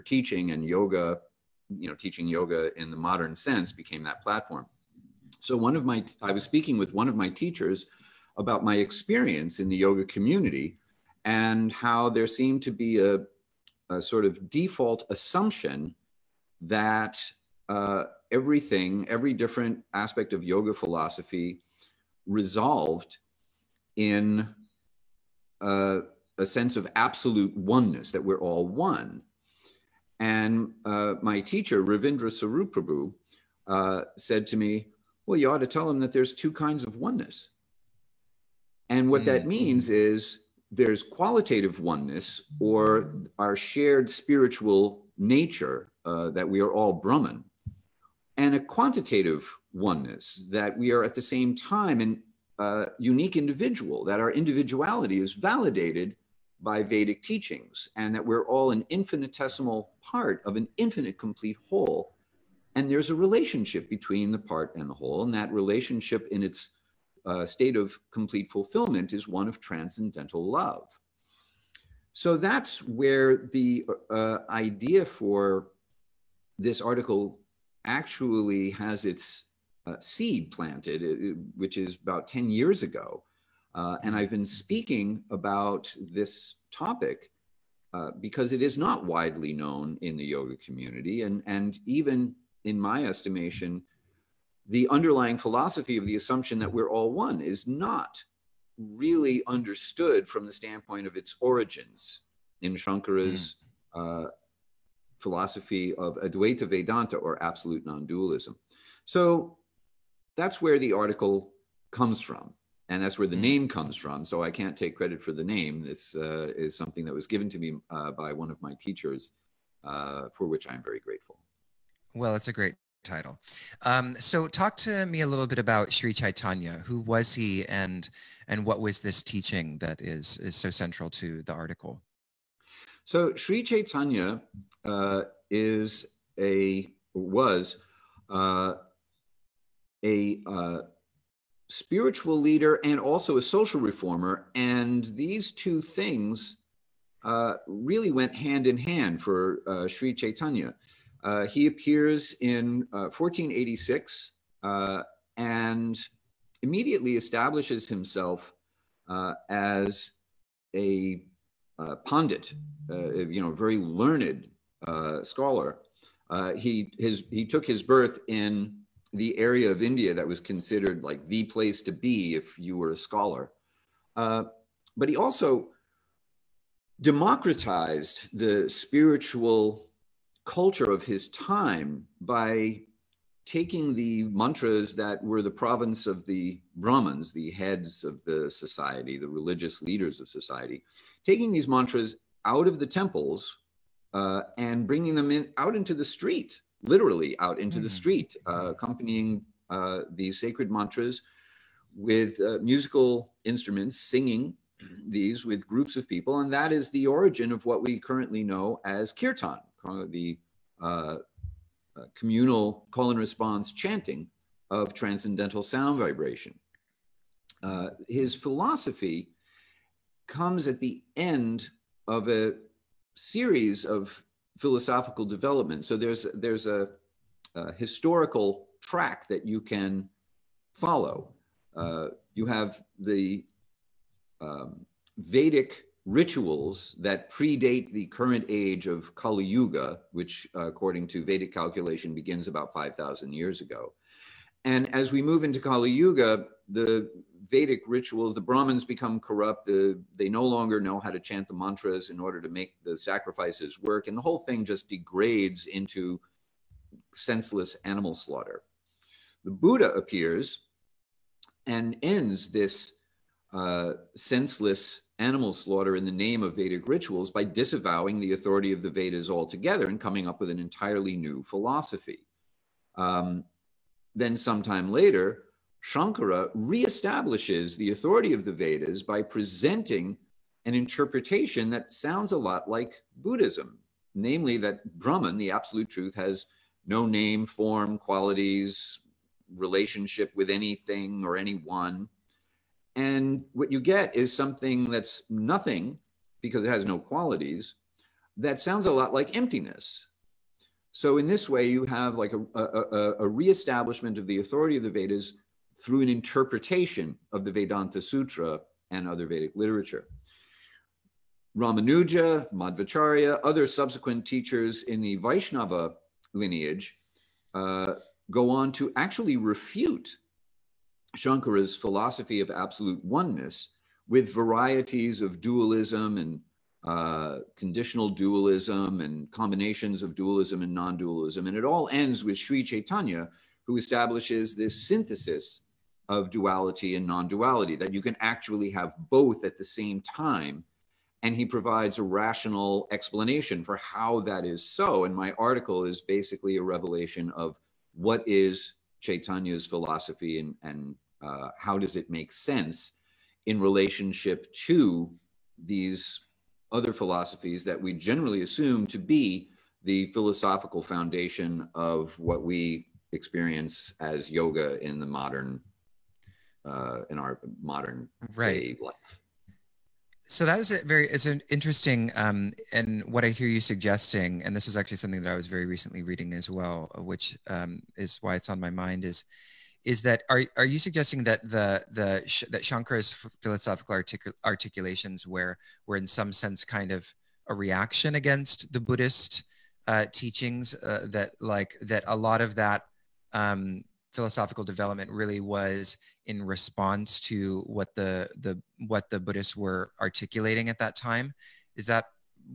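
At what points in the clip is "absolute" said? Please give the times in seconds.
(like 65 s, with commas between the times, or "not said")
26 s, 107 s, 285 s, 322 s.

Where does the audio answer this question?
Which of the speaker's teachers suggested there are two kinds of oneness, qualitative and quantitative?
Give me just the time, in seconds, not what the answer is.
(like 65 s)
31 s.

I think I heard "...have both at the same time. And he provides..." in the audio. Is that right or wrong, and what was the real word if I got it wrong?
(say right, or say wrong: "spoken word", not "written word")
right.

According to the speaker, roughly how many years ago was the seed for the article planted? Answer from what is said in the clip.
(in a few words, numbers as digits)
10 years.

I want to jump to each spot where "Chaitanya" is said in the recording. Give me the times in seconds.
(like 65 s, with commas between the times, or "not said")
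126 s, 133 s, 150 s, 332 s, 348 s.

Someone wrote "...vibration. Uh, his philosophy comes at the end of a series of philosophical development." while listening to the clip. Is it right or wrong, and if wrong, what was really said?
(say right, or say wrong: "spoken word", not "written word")
right.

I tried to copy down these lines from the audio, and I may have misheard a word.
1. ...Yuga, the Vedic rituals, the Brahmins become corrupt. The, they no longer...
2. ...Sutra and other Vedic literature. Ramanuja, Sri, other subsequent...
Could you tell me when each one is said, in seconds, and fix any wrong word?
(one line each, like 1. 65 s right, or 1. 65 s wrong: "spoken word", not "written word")
1. 245 s right
2. 308 s wrong: "Madhvacharya", not "Sri".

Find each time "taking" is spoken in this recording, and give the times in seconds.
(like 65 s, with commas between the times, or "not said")
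183 s, 191 s.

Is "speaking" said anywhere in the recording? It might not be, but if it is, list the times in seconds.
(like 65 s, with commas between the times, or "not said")
6 s, 84 s.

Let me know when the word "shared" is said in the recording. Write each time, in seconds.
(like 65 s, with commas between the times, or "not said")
43 s.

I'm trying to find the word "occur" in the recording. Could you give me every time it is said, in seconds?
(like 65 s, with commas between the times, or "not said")
not said.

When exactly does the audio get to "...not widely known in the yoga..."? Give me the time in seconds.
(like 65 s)
88 s.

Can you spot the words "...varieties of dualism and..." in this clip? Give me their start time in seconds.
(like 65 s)
324 s.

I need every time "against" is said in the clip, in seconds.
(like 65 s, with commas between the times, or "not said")
388 s.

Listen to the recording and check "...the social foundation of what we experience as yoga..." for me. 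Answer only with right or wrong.
wrong.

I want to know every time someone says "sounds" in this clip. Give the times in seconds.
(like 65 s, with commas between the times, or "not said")
215 s, 281 s, 298 s.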